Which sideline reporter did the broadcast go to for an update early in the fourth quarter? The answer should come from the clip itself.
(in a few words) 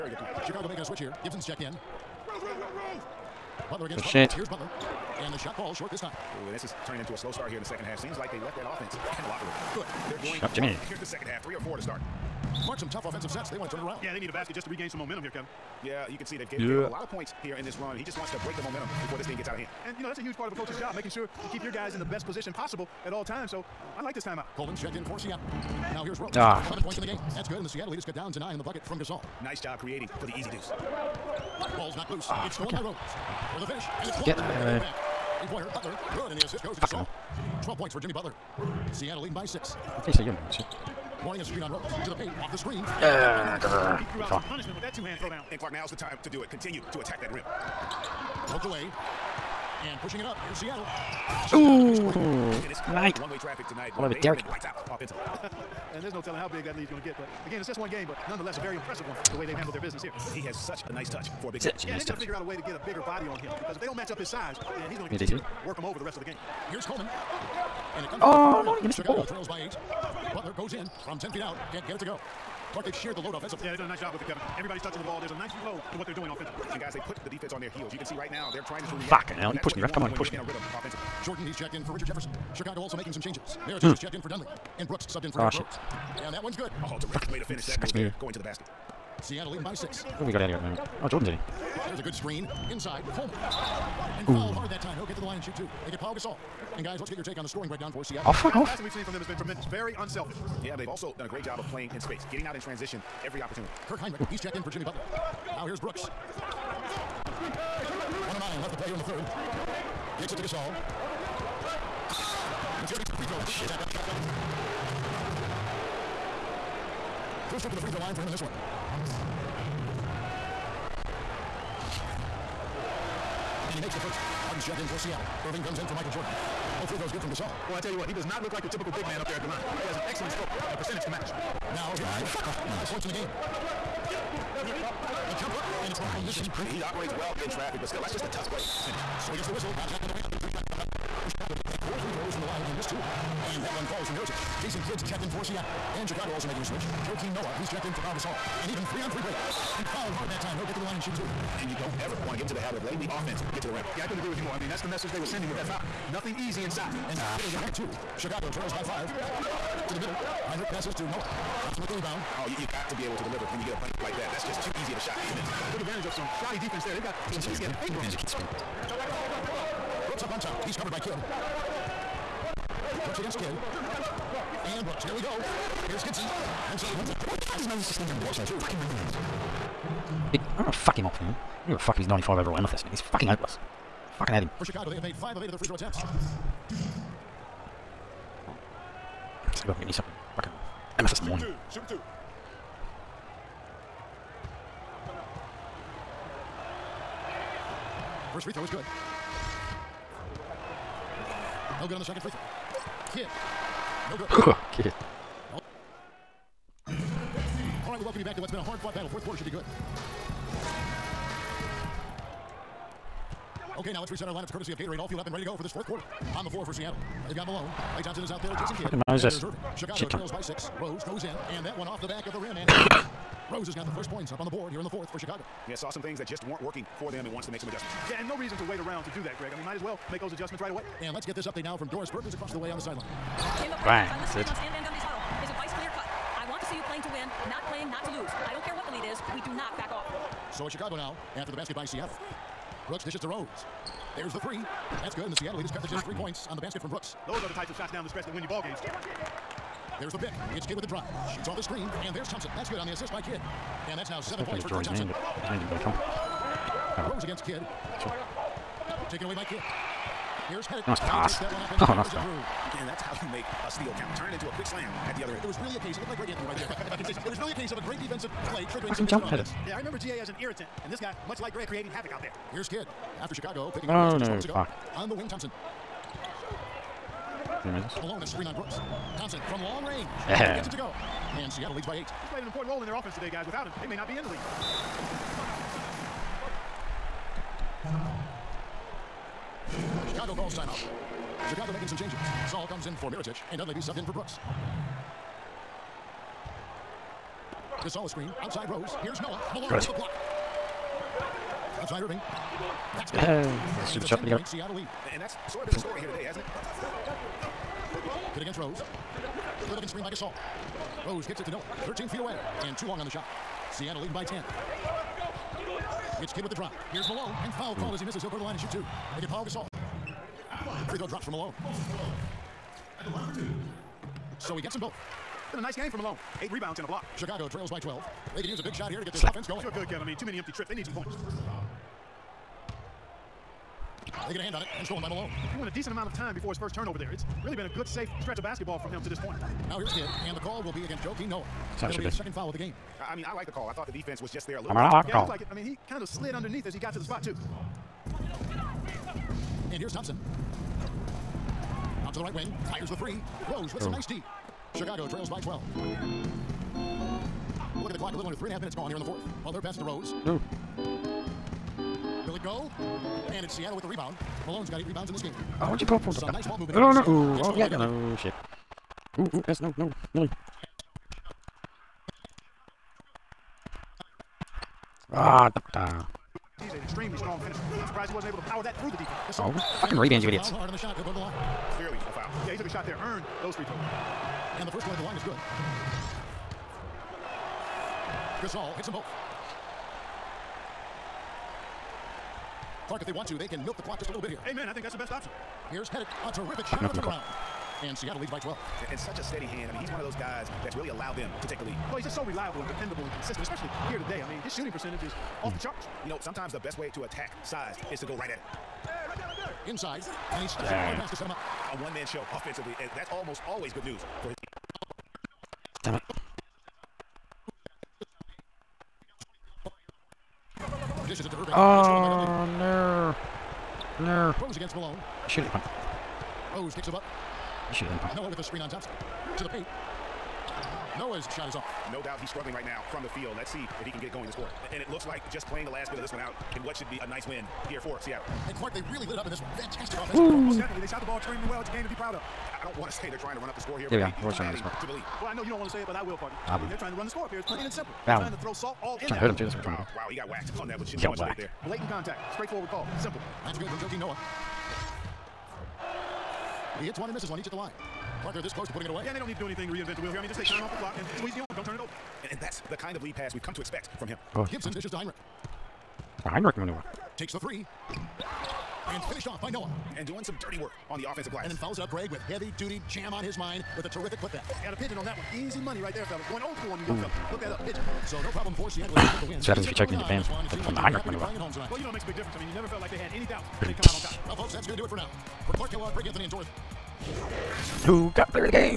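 Doris Burke.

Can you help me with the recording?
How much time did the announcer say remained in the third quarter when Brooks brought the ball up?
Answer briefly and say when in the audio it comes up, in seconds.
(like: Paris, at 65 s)
1:09, at 108 s.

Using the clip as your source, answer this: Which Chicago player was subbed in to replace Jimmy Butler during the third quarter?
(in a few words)
Kirk Hinrich.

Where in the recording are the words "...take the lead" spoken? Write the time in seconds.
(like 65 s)
401 s.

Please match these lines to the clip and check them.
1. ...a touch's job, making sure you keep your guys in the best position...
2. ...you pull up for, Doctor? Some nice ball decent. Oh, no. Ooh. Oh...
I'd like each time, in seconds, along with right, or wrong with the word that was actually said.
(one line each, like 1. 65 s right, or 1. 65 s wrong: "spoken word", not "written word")
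1. 20 s wrong: "coach", not "touch"
2. 365 s wrong: "movement", not "decent".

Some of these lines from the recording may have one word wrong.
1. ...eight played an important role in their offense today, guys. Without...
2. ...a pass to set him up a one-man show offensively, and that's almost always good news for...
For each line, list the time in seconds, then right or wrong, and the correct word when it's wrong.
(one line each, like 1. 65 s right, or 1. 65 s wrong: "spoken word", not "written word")
1. 281 s right
2. 410 s right.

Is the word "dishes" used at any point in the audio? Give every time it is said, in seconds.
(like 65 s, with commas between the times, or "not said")
243 s, 421 s, 464 s.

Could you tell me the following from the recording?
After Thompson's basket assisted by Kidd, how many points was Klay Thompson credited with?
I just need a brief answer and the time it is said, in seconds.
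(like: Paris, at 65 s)
7, at 254 s.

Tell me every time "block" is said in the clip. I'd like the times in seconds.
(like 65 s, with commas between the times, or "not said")
299 s, 326 s.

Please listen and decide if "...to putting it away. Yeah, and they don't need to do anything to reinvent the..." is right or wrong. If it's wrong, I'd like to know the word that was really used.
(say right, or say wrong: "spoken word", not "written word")
right.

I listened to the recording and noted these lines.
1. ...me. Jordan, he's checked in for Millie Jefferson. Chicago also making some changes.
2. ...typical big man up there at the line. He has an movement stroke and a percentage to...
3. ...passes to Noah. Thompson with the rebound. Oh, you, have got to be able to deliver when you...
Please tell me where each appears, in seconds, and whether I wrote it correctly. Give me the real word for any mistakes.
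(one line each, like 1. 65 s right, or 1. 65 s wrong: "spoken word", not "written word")
1. 80 s wrong: "Richard", not "Millie"
2. 128 s wrong: "excellent", not "movement"
3. 160 s right.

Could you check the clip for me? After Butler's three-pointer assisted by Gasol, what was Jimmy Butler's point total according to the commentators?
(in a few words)
12.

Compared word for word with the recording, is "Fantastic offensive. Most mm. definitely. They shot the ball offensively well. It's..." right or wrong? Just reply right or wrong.
wrong.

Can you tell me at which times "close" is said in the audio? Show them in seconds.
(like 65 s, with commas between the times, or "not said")
458 s.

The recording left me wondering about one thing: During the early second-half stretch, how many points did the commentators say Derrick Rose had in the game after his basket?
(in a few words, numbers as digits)
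11.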